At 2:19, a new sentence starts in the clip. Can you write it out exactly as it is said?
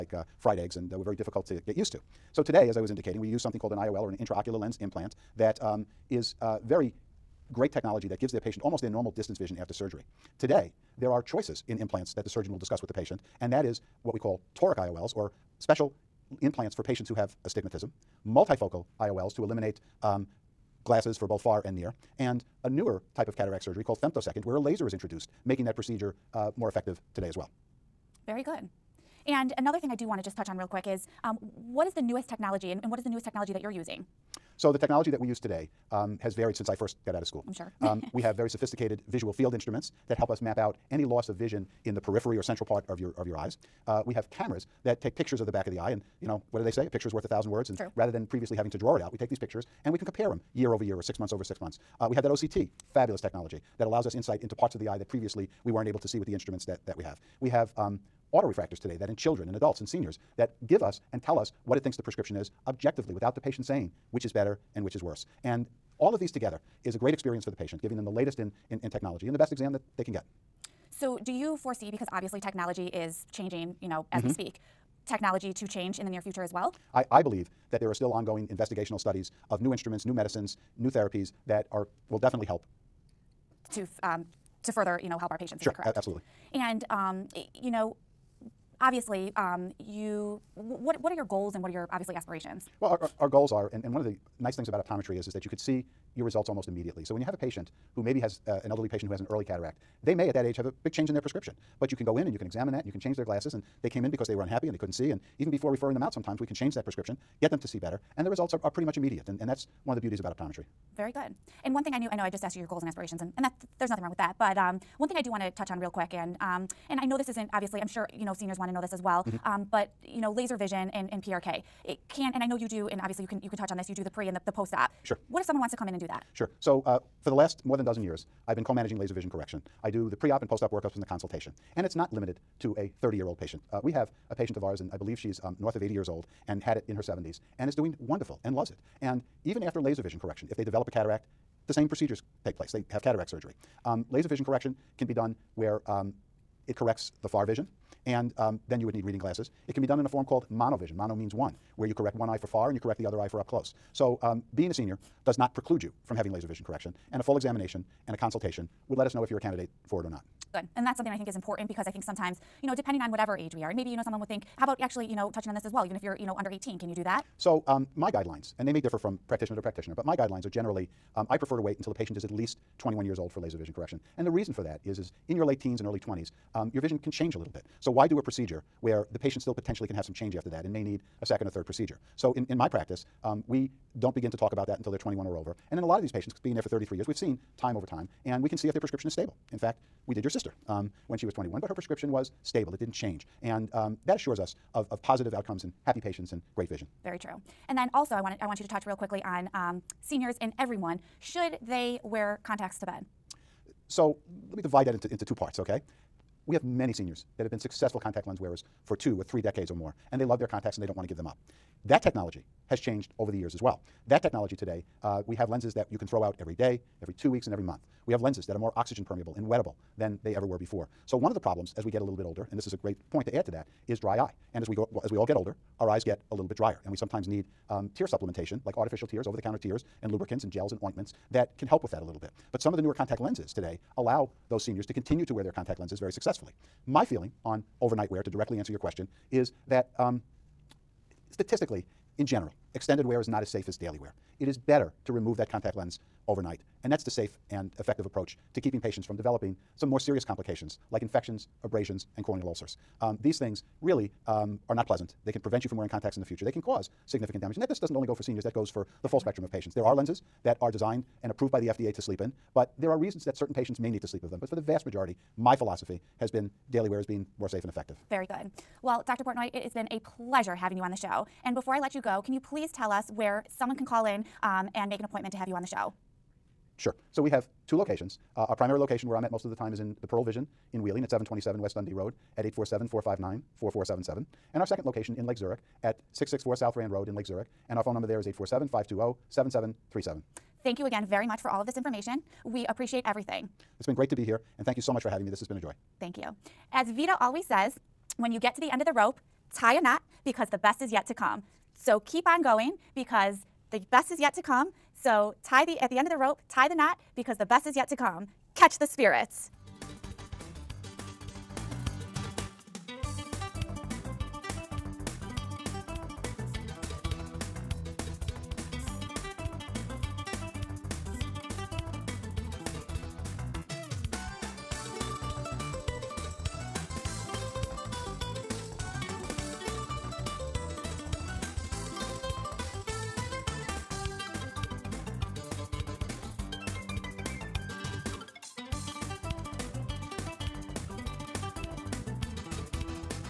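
And even after laser vision correction, if they develop a cataract, the same procedures take place.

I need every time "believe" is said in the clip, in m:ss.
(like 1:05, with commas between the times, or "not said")
1:17, 2:14.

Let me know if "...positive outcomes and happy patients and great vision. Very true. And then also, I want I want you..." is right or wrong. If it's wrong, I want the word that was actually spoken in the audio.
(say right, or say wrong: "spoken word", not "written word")
right.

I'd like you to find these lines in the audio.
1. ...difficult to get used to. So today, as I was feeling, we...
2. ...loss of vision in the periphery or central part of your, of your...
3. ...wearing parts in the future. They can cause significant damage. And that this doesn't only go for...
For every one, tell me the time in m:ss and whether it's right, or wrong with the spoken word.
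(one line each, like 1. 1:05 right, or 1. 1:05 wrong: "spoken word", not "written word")
1. 0:01 wrong: "indicating", not "feeling"
2. 0:41 right
3. 4:15 wrong: "contacts", not "parts".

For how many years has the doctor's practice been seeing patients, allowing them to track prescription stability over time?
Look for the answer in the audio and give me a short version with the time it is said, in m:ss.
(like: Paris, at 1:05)
33, at 3:06.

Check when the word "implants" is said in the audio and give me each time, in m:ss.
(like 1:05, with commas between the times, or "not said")
0:04, 0:11, 0:16.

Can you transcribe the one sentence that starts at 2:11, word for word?
And it's not limited to a 30-year-old patient.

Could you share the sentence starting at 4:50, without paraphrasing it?
Thank you again very much for all of this information.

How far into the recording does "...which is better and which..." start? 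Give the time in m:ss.
1:04.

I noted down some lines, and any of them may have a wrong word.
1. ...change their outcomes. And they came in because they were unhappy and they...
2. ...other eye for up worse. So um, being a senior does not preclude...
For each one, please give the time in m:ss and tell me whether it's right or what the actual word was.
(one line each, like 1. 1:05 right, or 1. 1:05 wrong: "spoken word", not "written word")
1. 1:42 wrong: "glasses", not "outcomes"
2. 2:33 wrong: "close", not "worse".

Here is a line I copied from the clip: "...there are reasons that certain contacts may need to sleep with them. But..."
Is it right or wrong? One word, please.
wrong.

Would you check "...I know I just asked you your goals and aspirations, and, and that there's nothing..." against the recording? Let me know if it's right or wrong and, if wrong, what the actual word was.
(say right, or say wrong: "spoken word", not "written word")
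right.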